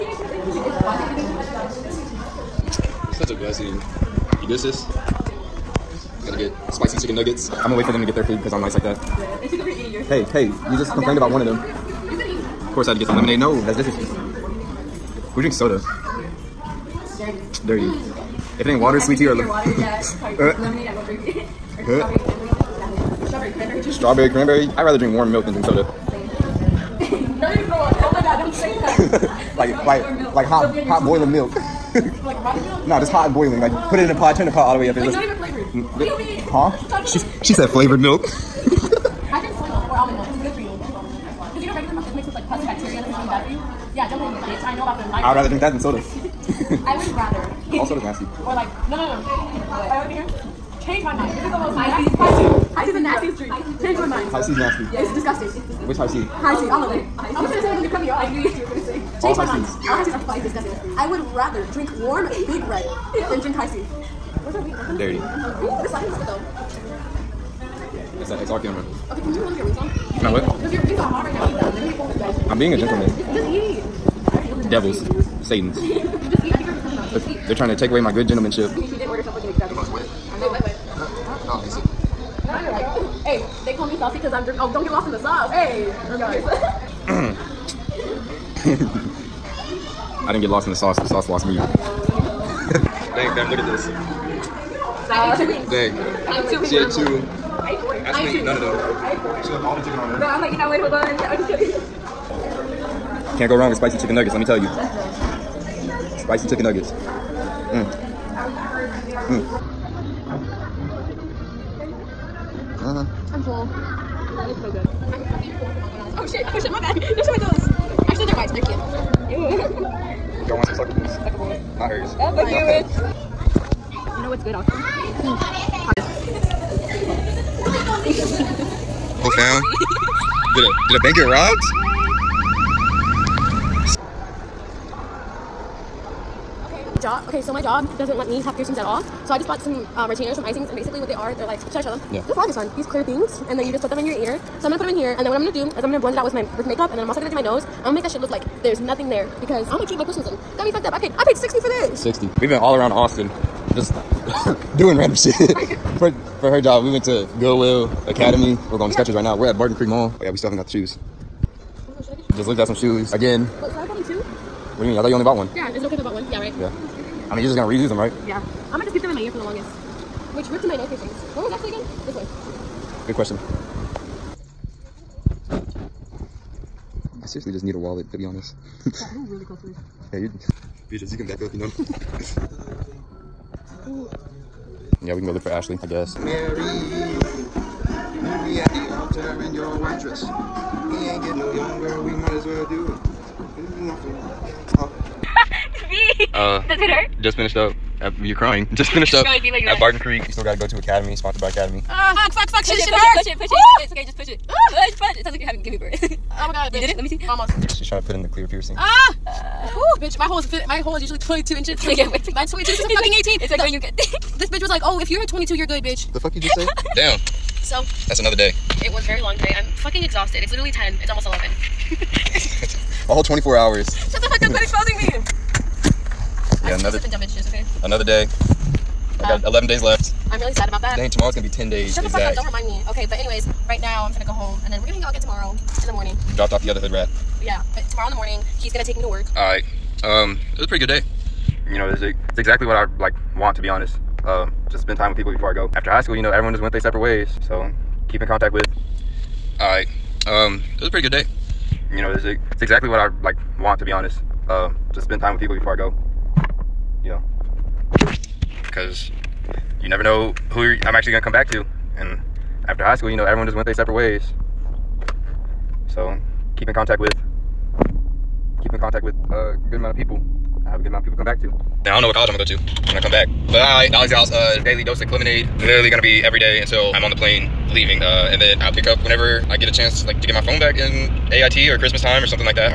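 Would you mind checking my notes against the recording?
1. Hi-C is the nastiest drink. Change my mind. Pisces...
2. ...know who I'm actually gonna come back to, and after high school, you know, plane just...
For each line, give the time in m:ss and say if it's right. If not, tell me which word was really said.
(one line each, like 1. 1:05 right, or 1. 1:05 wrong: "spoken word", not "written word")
1. 0:52 right
2. 4:20 wrong: "everyone", not "plane".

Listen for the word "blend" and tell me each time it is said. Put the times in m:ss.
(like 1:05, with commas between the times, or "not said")
2:25.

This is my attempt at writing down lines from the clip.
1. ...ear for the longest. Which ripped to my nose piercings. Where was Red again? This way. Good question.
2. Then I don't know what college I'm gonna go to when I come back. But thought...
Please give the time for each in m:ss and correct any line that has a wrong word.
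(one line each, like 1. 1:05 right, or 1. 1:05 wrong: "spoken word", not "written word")
1. 2:49 wrong: "Ashley", not "Red"
2. 4:31 wrong: "alright", not "thought".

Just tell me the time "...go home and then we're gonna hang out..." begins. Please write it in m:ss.
3:54.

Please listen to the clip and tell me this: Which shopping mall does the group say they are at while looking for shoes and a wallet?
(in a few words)
Barton Creek Mall.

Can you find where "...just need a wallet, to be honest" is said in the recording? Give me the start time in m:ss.
2:57.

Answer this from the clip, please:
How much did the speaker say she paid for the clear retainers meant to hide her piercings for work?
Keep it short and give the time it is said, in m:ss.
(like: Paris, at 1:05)
$60, at 2:31.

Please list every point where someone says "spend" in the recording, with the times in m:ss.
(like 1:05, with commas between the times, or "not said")
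4:04, 4:15.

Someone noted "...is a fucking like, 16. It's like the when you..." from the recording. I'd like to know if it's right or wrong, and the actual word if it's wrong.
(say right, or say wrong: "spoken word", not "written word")
wrong: "18", not "16".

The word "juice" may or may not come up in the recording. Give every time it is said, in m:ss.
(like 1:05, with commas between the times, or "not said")
0:23, 3:47.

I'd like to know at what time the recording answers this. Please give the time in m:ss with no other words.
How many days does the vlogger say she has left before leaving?
3:49.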